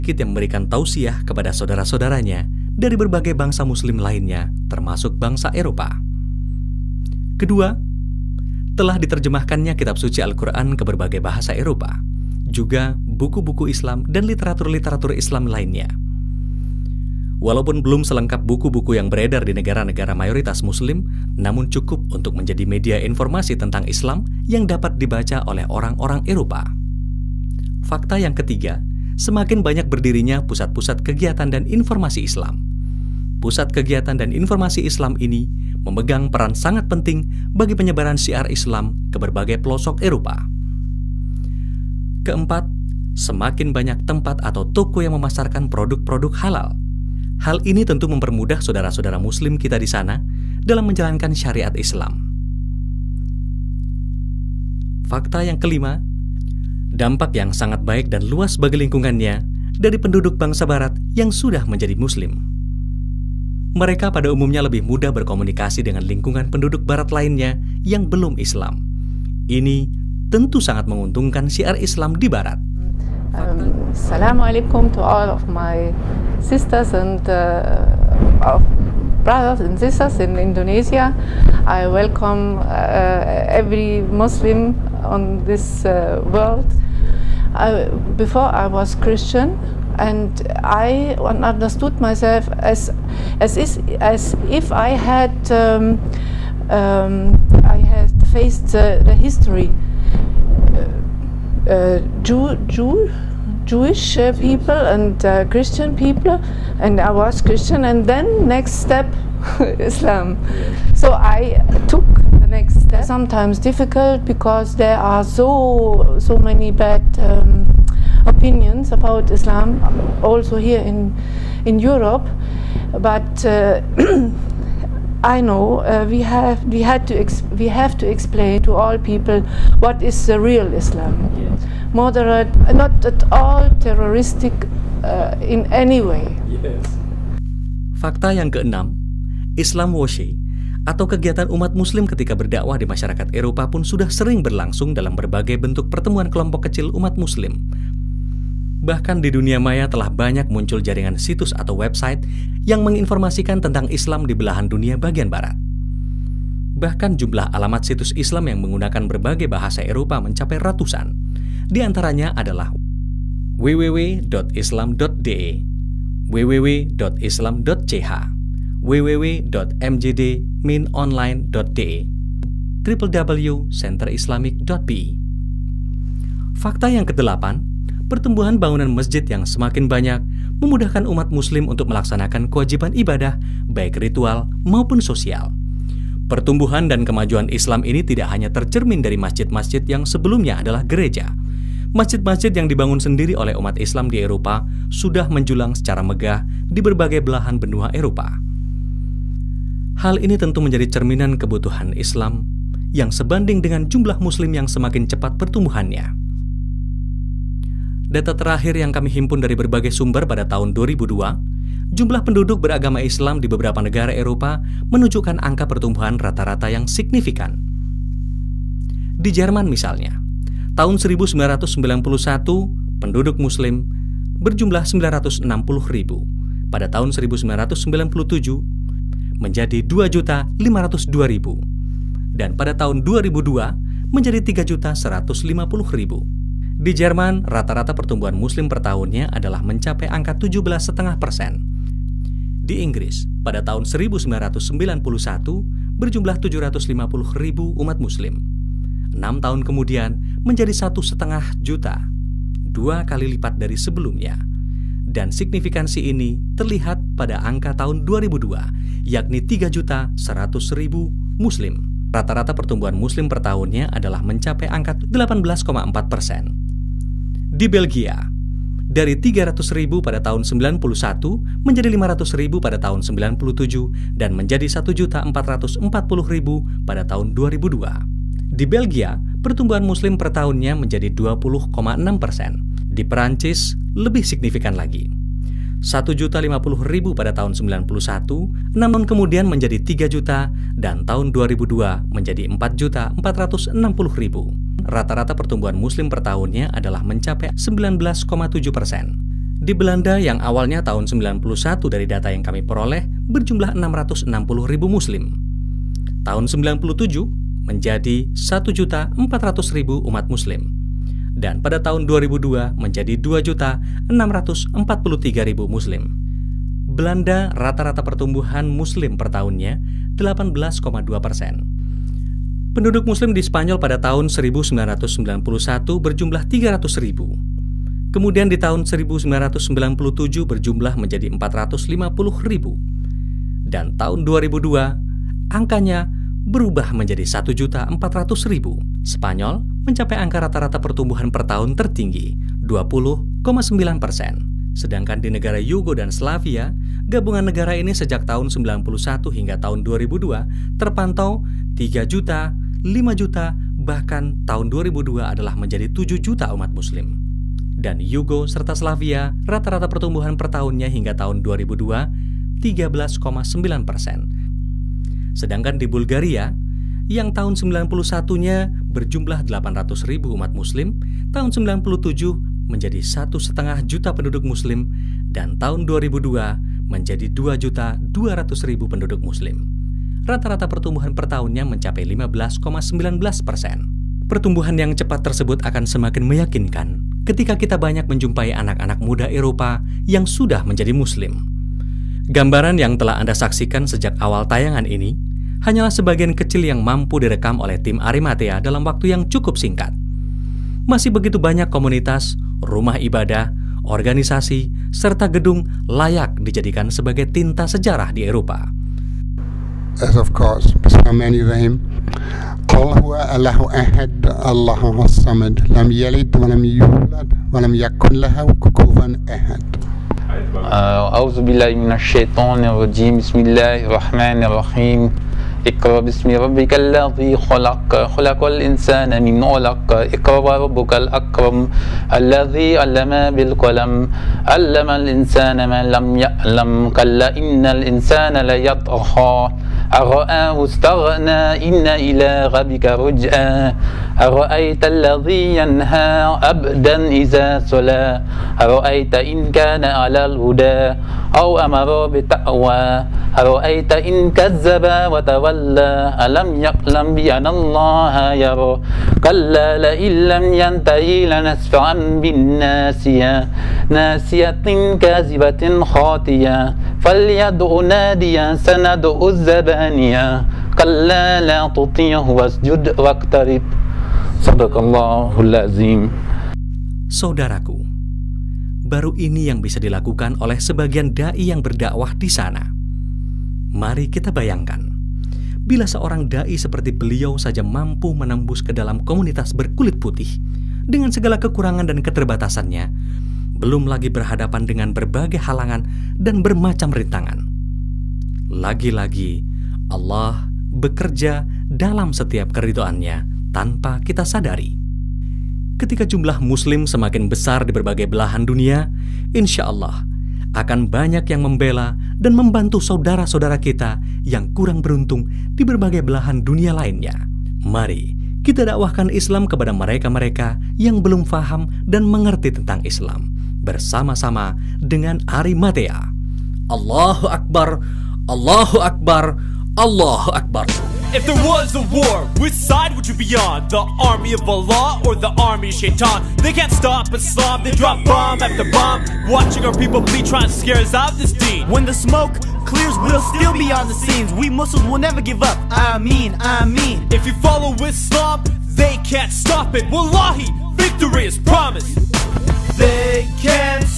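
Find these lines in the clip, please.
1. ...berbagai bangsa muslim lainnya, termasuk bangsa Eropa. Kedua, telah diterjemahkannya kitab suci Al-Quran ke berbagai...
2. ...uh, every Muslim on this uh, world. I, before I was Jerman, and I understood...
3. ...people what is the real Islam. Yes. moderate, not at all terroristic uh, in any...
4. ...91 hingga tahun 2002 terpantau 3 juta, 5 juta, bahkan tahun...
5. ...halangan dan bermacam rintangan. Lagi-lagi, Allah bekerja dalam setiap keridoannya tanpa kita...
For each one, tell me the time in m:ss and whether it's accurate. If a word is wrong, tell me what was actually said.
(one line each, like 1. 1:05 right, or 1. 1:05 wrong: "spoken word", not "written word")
1. 0:02 right
2. 1:22 wrong: "Christian", not "Jerman"
3. 2:08 right
4. 5:48 right
5. 8:15 right.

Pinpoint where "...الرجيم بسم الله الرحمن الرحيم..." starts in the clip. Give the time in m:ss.
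7:02.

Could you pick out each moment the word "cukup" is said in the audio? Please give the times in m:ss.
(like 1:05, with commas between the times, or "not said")
0:21, 6:39.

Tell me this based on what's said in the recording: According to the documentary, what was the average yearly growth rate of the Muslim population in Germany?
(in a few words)
17.5 percent.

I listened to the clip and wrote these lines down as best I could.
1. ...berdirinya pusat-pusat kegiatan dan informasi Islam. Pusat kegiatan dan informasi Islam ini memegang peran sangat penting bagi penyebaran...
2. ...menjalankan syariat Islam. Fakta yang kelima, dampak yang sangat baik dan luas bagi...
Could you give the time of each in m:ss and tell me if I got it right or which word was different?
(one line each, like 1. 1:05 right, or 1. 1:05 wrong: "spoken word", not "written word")
1. 0:29 right
2. 0:50 right.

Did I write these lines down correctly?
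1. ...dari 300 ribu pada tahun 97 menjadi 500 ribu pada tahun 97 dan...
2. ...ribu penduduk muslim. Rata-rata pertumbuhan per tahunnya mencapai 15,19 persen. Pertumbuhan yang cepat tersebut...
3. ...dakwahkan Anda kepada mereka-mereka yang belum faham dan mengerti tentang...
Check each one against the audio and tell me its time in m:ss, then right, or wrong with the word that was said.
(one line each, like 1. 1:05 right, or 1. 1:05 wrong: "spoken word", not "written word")
1. 4:28 wrong: "91", not "97"
2. 6:18 right
3. 8:38 wrong: "Islam", not "Anda".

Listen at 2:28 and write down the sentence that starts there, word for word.
Bahkan di dunia maya telah banyak muncul jaringan situs atau website yang menginformasikan tentang Islam di belahan dunia bagian barat.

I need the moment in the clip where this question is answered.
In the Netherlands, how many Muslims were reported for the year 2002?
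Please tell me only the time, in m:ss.
5:13.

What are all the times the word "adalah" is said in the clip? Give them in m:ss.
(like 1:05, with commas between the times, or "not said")
2:42, 3:10, 3:59, 4:23, 4:56, 5:55.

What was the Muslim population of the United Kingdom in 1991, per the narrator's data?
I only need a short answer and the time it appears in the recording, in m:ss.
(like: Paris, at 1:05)
750,000, at 4:06.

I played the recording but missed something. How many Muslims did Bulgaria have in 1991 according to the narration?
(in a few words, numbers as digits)
800,000.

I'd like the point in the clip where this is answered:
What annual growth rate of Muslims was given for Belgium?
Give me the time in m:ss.
4:41.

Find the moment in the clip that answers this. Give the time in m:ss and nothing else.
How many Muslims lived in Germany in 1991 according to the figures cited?
3:44.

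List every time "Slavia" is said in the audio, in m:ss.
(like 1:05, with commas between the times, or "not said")
5:46, 5:58.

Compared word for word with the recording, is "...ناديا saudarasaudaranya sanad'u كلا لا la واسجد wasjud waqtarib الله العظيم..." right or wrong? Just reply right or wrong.
wrong.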